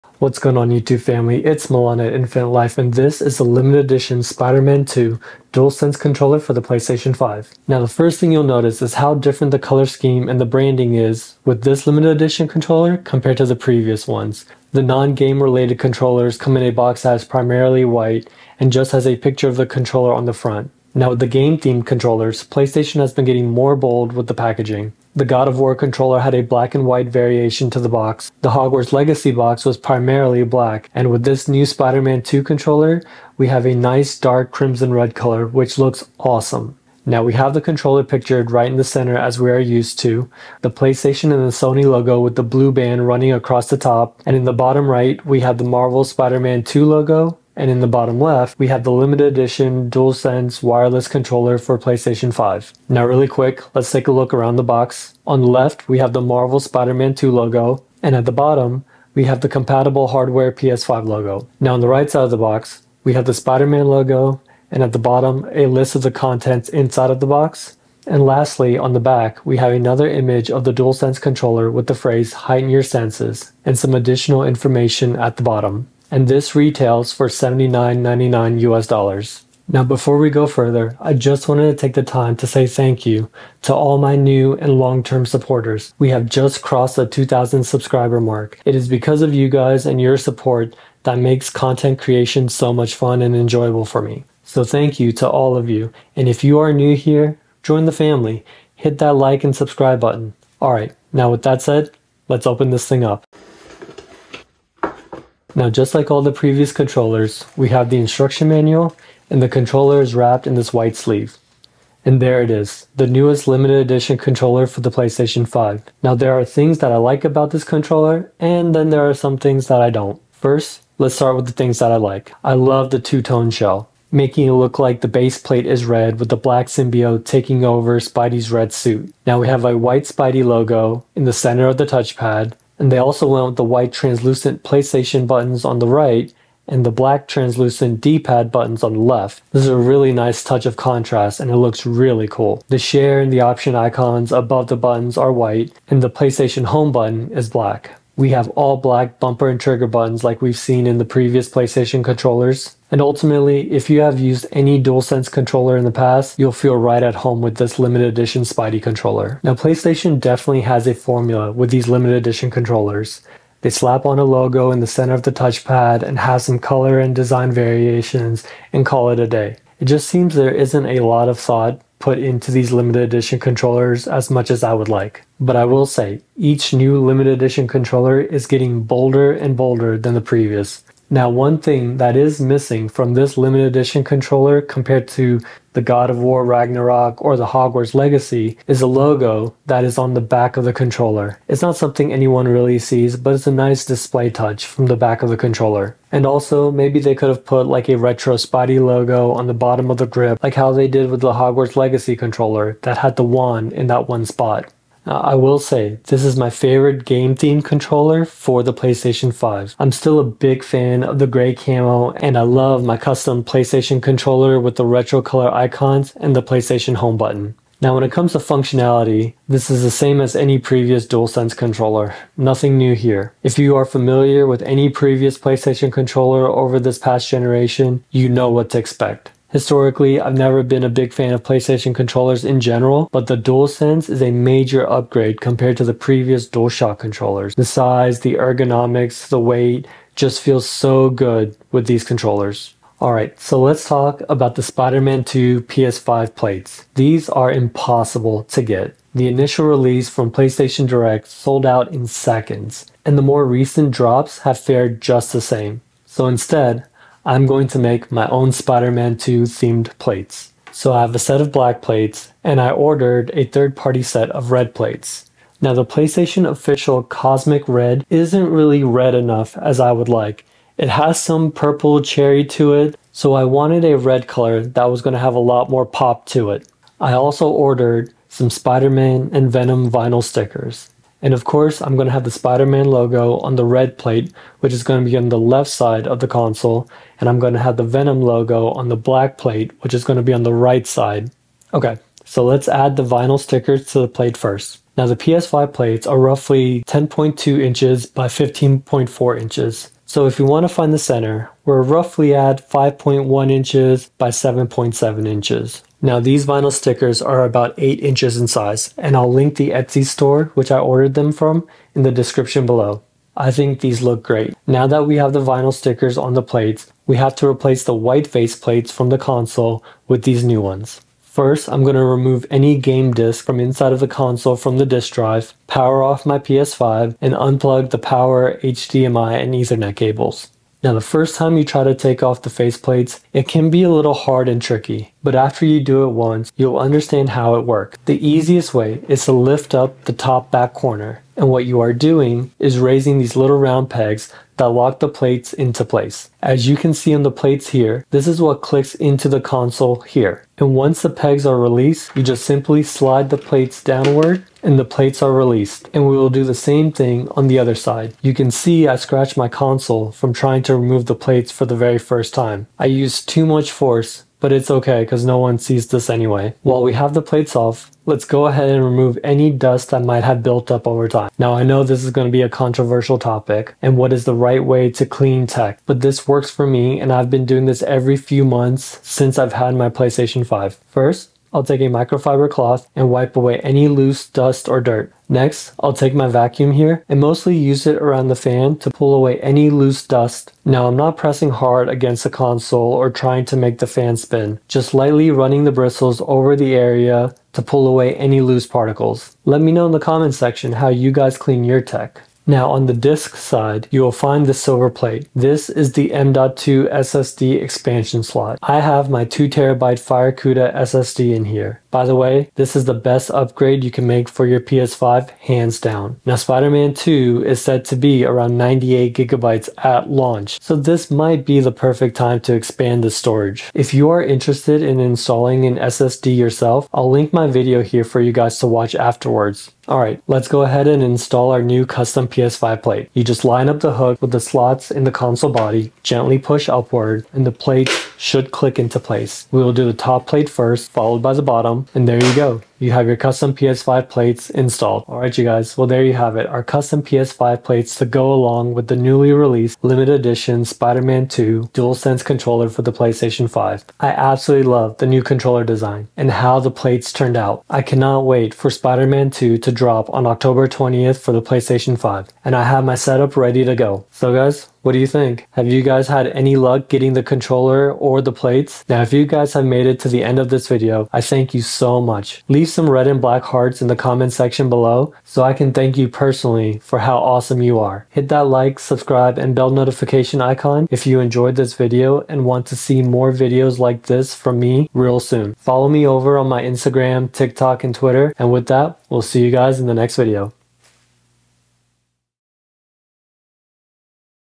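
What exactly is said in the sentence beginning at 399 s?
Let me know in the comments section how you guys clean your tech.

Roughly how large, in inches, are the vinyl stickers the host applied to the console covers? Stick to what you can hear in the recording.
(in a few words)
8 inches.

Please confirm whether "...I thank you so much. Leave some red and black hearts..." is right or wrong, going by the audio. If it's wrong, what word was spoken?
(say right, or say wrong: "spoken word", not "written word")
right.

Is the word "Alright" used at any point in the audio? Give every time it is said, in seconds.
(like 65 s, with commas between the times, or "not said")
243 s.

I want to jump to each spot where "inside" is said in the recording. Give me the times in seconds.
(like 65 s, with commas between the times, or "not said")
66 s, 323 s.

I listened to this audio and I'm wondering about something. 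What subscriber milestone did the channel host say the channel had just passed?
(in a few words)
2,000.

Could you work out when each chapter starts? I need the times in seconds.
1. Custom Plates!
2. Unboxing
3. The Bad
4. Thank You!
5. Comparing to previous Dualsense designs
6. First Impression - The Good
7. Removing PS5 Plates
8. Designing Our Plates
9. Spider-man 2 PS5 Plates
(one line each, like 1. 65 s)
1. 255 s
2. 100 s
3. 159 s
4. 79 s
5. 204 s
6. 115 s
7. 330 s
8. 291 s
9. 242 s.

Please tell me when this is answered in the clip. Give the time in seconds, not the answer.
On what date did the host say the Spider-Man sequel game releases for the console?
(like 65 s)
460 s.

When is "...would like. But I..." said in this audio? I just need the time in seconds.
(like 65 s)
174 s.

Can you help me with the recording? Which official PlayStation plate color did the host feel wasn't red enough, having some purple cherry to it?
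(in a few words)
Cosmic Red.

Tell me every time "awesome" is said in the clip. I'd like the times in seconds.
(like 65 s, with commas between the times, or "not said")
36 s, 477 s.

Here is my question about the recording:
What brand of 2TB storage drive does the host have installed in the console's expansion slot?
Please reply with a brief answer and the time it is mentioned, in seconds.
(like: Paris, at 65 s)
Firecuda, at 409 s.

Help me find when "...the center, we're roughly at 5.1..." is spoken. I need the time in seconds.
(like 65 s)
300 s.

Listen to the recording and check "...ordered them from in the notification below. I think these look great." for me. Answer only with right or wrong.
wrong.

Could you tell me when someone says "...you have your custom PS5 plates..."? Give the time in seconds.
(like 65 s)
442 s.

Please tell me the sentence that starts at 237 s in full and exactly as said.
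The size, the ergonomics, the weight just feels so good with these controllers.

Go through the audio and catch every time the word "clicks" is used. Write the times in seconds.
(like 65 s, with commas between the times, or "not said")
348 s, 438 s.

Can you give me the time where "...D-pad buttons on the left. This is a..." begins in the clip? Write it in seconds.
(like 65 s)
138 s.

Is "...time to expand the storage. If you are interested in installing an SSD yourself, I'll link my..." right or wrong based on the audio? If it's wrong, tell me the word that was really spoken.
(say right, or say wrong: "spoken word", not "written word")
right.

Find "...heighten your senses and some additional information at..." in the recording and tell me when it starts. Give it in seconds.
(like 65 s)
72 s.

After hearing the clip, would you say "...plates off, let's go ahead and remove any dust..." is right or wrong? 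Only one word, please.
right.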